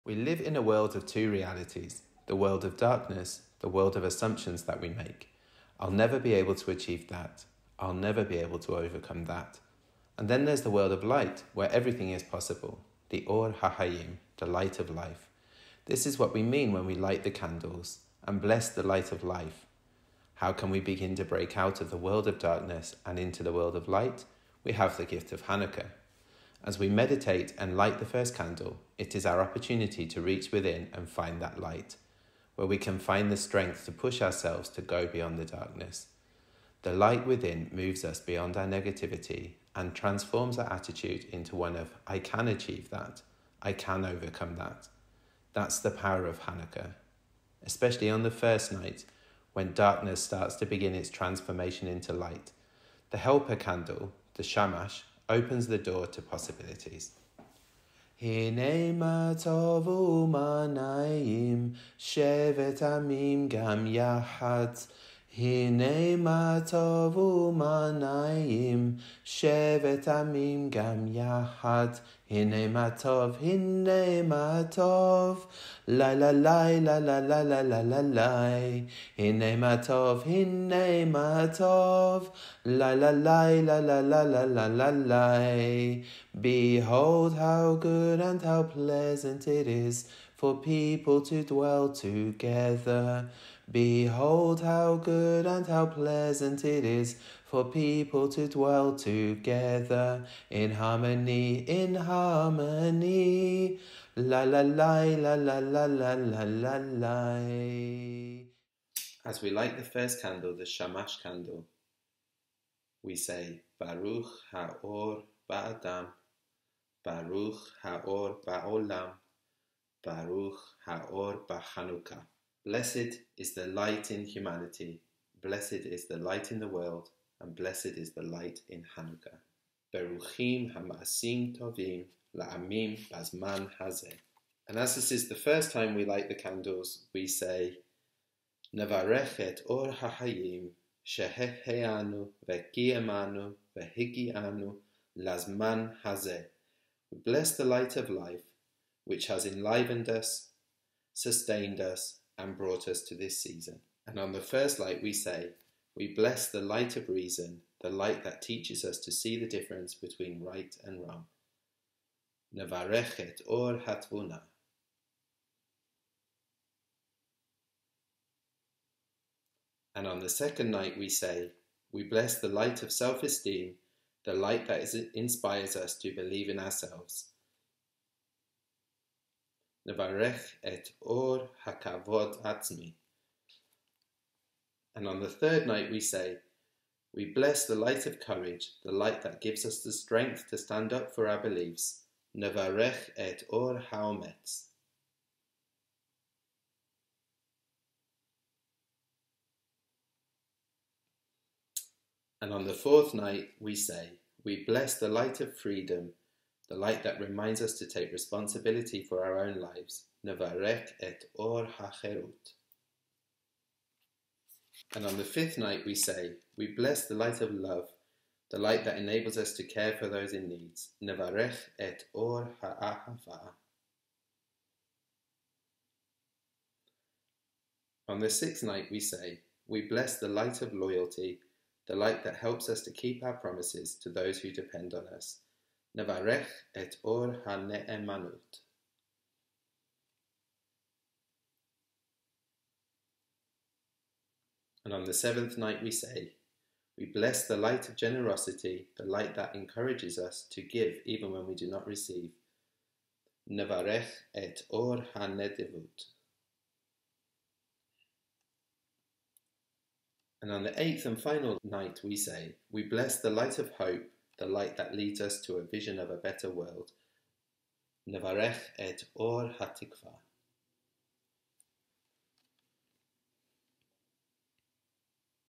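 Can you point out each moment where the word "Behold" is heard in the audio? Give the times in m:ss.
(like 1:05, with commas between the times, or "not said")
1:26, 1:33.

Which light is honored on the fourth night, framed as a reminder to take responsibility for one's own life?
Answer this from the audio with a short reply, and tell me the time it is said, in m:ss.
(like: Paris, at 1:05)
freedom, at 3:25.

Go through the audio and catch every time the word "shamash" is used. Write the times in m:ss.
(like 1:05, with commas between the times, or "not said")
0:54, 1:50.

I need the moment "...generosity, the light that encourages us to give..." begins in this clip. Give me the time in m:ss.
4:07.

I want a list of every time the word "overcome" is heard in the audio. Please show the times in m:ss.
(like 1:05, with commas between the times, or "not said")
0:08, 0:44.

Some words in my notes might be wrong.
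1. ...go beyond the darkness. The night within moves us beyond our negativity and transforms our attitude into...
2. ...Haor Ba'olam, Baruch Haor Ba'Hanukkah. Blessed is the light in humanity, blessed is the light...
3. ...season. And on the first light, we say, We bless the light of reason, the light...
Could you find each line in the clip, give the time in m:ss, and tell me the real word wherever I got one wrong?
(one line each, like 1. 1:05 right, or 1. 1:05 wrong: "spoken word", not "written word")
1. 0:34 wrong: "light", not "night"
2. 1:57 right
3. 2:33 right.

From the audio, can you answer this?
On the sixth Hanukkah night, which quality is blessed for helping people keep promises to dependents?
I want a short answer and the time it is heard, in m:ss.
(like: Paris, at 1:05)
loyalty, at 3:50.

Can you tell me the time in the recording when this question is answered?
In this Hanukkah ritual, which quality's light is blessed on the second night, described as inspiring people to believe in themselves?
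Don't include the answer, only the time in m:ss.
2:52.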